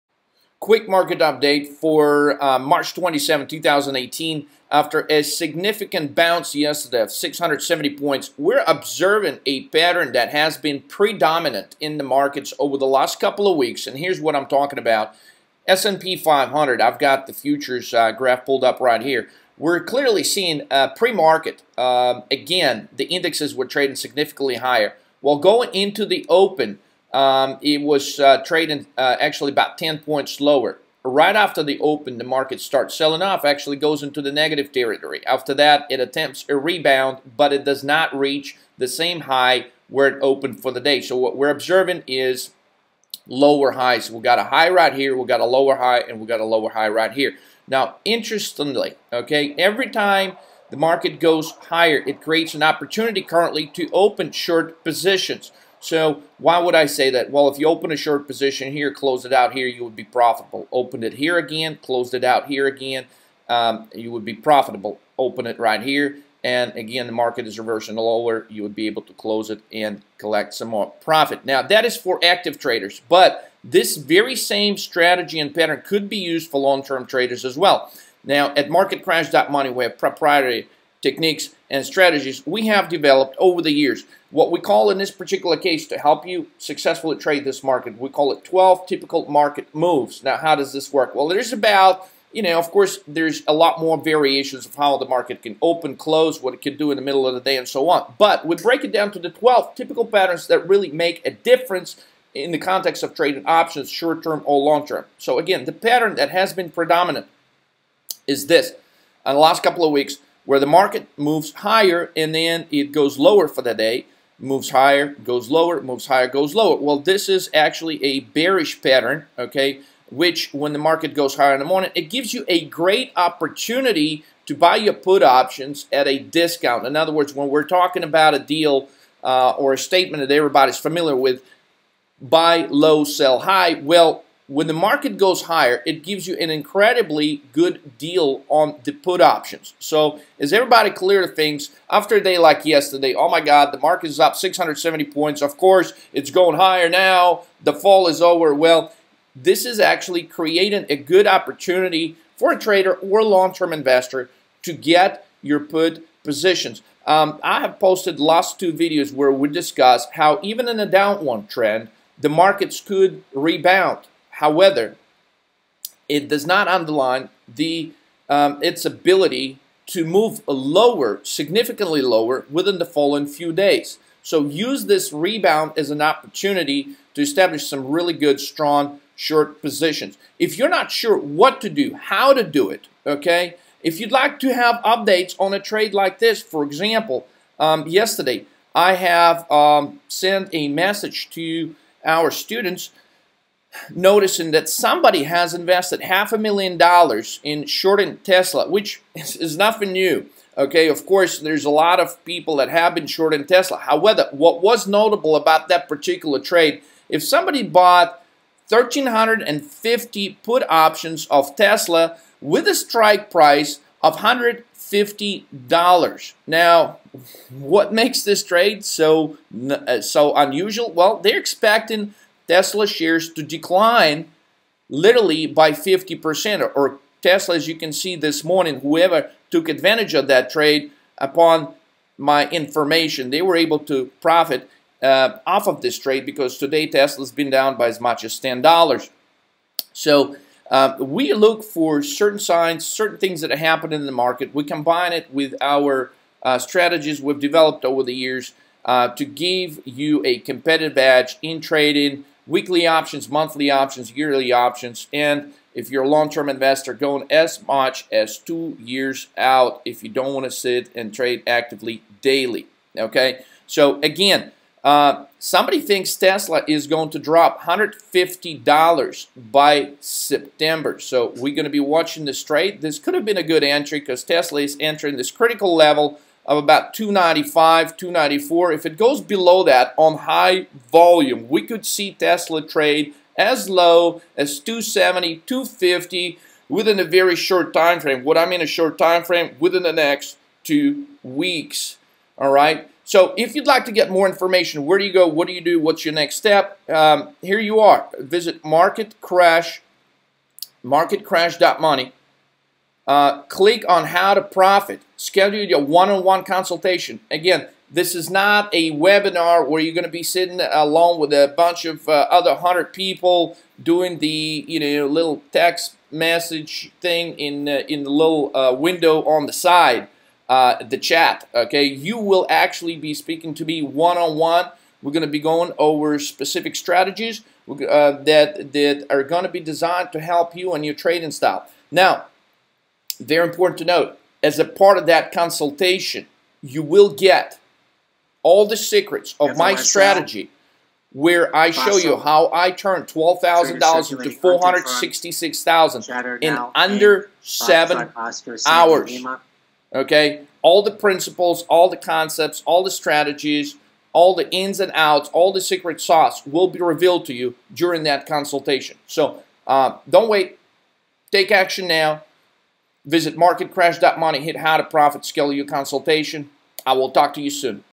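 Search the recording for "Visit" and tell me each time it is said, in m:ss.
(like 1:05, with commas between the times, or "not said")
4:58, 6:03.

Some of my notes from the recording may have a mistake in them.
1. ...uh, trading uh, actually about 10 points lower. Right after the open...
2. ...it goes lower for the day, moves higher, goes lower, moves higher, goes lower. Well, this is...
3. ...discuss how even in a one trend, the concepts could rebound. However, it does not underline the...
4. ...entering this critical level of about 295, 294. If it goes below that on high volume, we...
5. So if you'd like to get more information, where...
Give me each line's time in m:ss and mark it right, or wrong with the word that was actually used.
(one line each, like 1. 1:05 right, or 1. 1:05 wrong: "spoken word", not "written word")
1. 0:28 right
2. 1:52 right
3. 2:39 wrong: "markets", not "concepts"
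4. 4:34 right
5. 4:53 right.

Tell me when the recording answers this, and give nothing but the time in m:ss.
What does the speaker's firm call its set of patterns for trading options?
1:28.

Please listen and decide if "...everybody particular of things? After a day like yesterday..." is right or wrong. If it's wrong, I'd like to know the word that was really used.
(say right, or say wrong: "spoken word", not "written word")
wrong: "clear", not "particular".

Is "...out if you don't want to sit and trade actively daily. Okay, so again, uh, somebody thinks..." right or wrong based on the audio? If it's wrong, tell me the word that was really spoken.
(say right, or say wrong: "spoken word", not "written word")
right.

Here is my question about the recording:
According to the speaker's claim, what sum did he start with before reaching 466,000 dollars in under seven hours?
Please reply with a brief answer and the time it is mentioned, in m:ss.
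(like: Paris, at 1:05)
$12,000, at 5:43.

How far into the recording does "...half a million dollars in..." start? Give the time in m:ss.
3:16.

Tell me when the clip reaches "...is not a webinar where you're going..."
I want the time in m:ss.
5:08.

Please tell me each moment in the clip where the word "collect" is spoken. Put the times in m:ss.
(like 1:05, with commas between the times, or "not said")
1:10.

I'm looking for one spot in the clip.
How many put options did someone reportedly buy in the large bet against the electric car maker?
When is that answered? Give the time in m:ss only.
3:28.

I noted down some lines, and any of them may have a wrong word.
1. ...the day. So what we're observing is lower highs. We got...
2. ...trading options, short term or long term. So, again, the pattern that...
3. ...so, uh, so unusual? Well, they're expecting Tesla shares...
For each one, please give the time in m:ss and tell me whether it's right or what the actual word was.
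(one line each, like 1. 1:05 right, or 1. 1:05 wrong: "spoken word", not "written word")
1. 0:40 right
2. 1:43 right
3. 3:38 right.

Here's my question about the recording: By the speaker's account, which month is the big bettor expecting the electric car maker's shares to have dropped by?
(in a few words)
September.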